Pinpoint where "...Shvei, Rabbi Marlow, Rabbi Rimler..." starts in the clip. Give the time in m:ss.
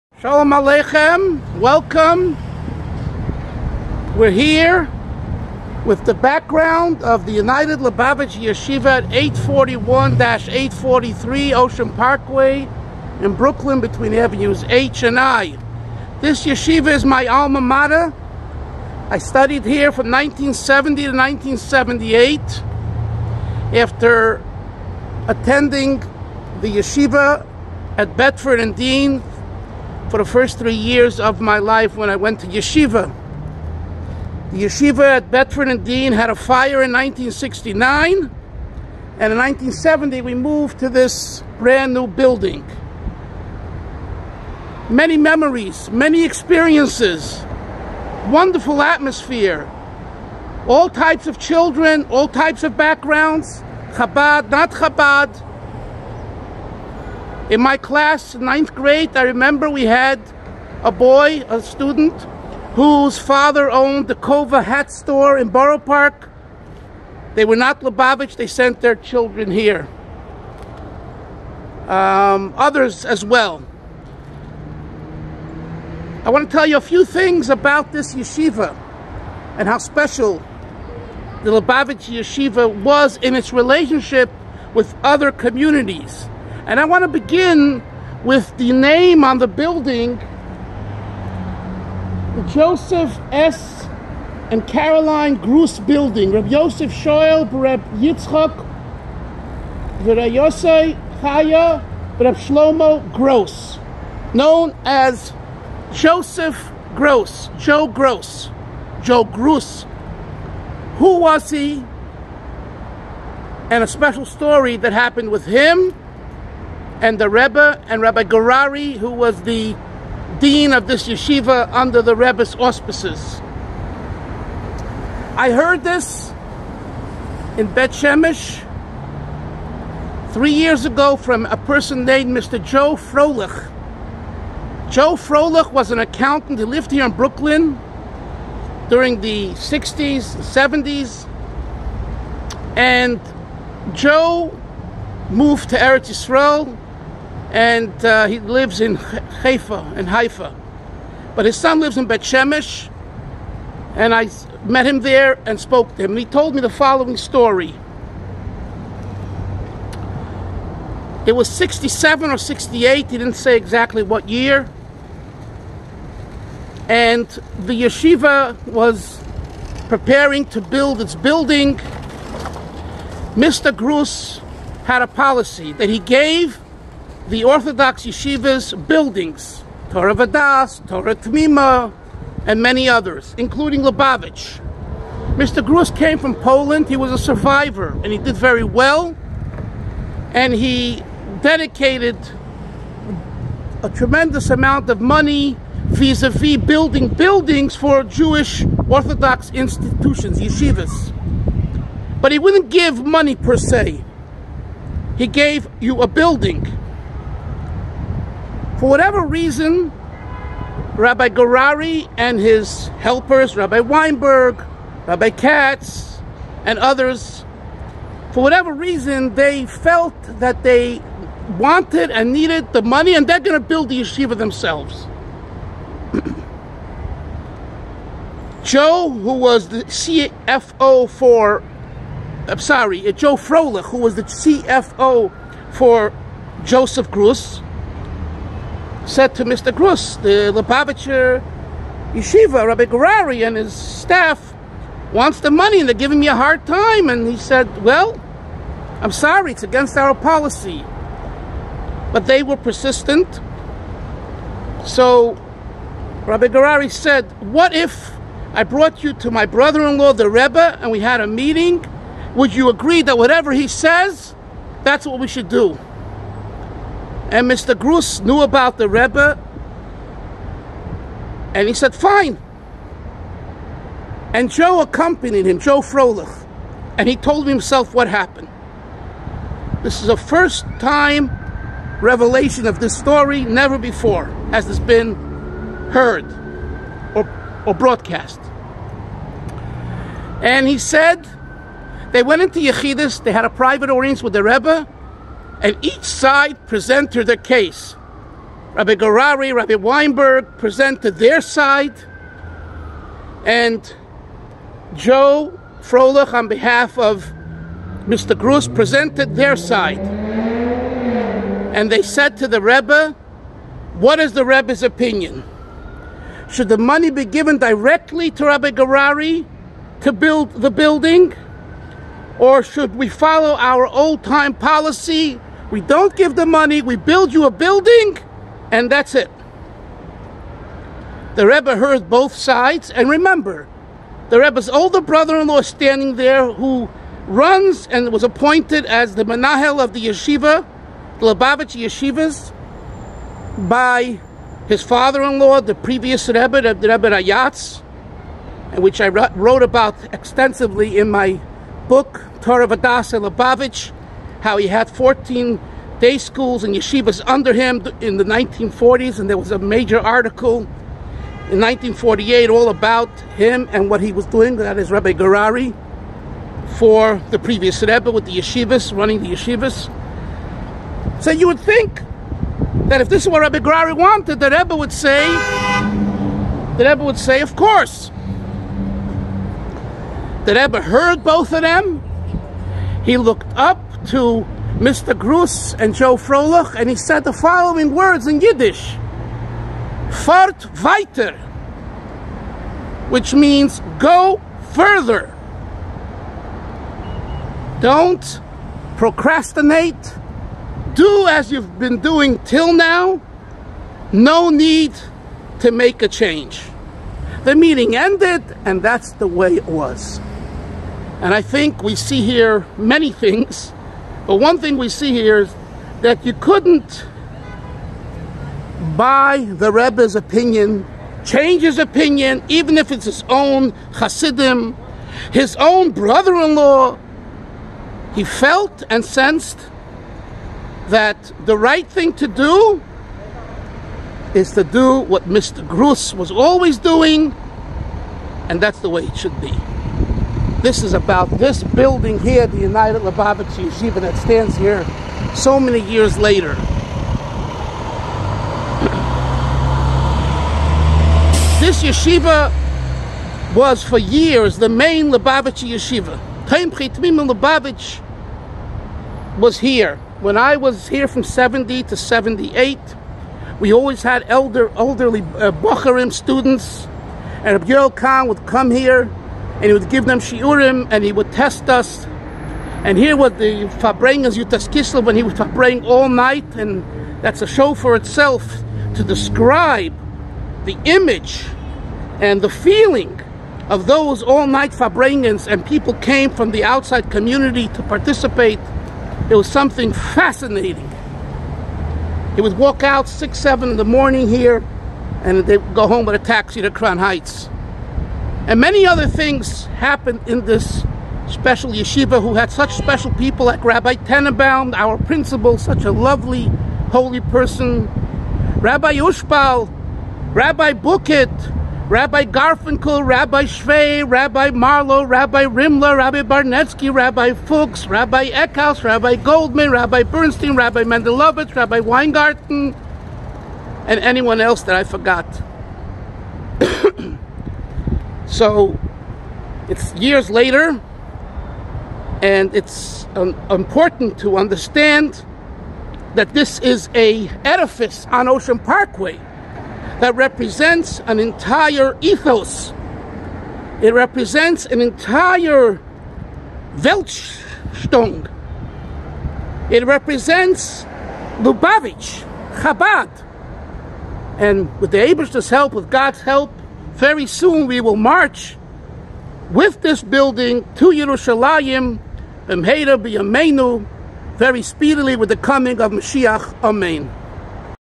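8:33.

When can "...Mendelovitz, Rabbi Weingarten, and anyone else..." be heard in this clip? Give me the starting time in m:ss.
8:40.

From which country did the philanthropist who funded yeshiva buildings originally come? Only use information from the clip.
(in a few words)
Poland.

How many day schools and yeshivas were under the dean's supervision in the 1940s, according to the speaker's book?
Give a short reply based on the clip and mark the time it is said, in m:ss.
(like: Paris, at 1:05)
14, at 5:54.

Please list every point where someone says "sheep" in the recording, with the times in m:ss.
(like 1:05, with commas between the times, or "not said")
not said.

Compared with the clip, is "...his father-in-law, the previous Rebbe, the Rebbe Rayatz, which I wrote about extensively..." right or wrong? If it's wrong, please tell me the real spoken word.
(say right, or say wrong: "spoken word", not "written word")
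right.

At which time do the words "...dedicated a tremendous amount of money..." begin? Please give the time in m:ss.
3:11.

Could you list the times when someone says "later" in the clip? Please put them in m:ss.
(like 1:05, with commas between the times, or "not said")
7:26, 8:50.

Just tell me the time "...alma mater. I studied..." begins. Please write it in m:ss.
0:17.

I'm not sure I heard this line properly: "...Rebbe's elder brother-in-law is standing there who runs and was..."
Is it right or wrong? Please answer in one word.
wrong.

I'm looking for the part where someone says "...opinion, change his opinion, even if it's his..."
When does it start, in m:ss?
7:00.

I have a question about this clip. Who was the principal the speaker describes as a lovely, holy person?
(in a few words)
Rabbi Tenenbaum.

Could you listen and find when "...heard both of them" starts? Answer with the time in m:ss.
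6:20.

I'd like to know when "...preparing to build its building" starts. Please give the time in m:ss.
2:49.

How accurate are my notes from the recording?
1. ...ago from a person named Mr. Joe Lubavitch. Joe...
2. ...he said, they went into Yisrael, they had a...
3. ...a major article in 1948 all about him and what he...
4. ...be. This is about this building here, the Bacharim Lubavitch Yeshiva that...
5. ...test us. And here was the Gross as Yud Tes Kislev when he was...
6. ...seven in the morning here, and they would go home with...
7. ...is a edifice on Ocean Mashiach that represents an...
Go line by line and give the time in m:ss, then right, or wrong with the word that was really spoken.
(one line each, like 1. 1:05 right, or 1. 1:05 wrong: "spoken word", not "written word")
1. 2:10 wrong: "Froelich", not "Lubavitch"
2. 4:50 wrong: "Yechidus", not "Yisrael"
3. 5:59 right
4. 7:19 wrong: "United", not "Bacharim"
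5. 7:51 wrong: "Fabreng", not "Gross"
6. 8:13 right
7. 8:56 wrong: "Parkway", not "Mashiach".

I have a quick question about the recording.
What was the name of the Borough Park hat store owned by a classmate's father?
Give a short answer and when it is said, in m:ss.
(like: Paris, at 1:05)
Kova, at 1:04.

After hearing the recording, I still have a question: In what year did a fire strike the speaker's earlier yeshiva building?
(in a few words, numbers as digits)
1969.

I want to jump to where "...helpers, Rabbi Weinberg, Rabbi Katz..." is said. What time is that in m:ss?
3:32.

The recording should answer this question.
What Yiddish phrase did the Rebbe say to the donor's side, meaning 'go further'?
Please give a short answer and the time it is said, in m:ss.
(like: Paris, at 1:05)
Fort weiter, at 6:30.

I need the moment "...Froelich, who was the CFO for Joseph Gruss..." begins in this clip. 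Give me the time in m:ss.
3:53.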